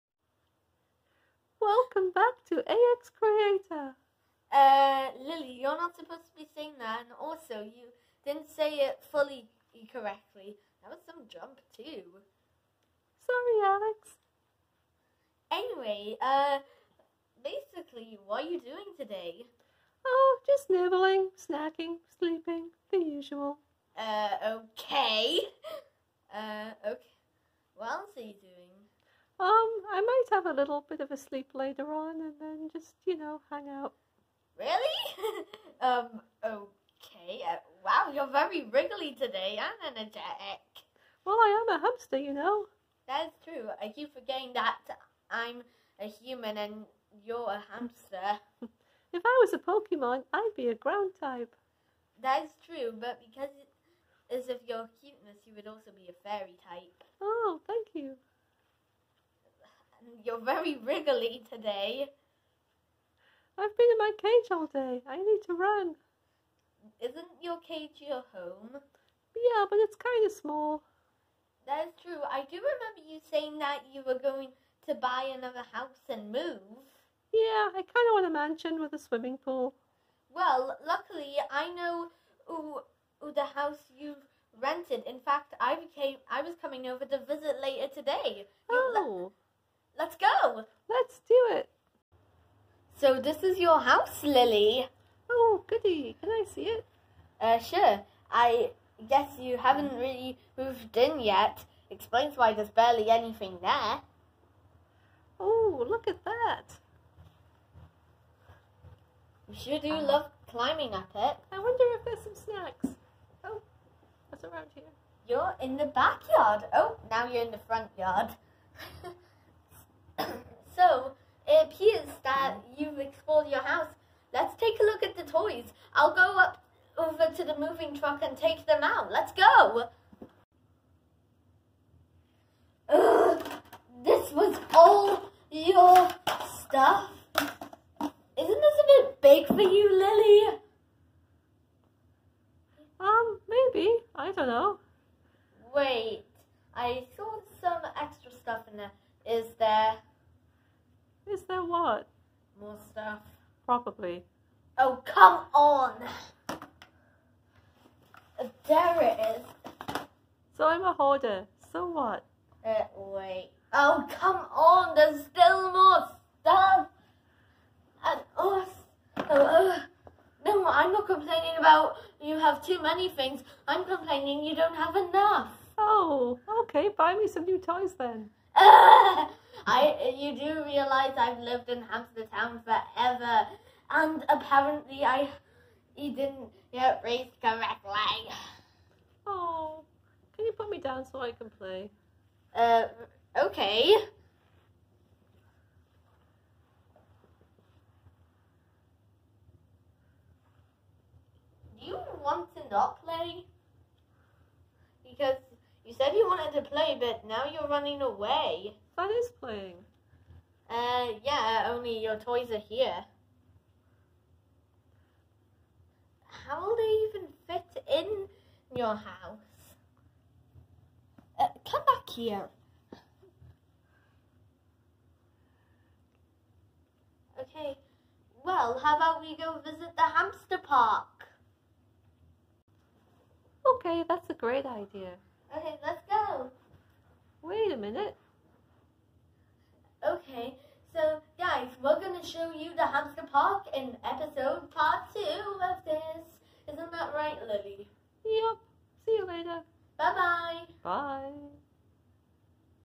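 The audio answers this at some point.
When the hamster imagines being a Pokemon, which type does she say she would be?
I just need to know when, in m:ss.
0:50.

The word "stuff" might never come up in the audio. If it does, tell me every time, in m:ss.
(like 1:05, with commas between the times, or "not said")
2:16, 2:28, 2:32, 2:46.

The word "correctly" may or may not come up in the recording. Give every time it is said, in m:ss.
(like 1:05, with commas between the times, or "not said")
0:09, 3:07.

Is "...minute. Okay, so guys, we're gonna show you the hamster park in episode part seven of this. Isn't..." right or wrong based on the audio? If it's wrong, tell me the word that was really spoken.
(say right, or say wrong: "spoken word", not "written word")
wrong: "two", not "seven".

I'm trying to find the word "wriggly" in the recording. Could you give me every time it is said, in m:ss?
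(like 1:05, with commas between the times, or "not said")
0:38, 1:00.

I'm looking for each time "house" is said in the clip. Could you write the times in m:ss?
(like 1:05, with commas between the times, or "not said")
1:15, 1:23, 1:33, 2:03, 3:38.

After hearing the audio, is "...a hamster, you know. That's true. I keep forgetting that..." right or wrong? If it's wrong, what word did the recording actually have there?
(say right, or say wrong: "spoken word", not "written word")
right.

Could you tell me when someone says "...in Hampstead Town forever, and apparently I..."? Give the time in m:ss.
3:01.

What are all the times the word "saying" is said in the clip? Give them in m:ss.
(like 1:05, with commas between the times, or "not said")
0:06, 1:13.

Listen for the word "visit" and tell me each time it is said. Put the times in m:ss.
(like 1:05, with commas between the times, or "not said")
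1:27, 3:49.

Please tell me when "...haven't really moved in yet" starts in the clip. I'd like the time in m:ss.
1:39.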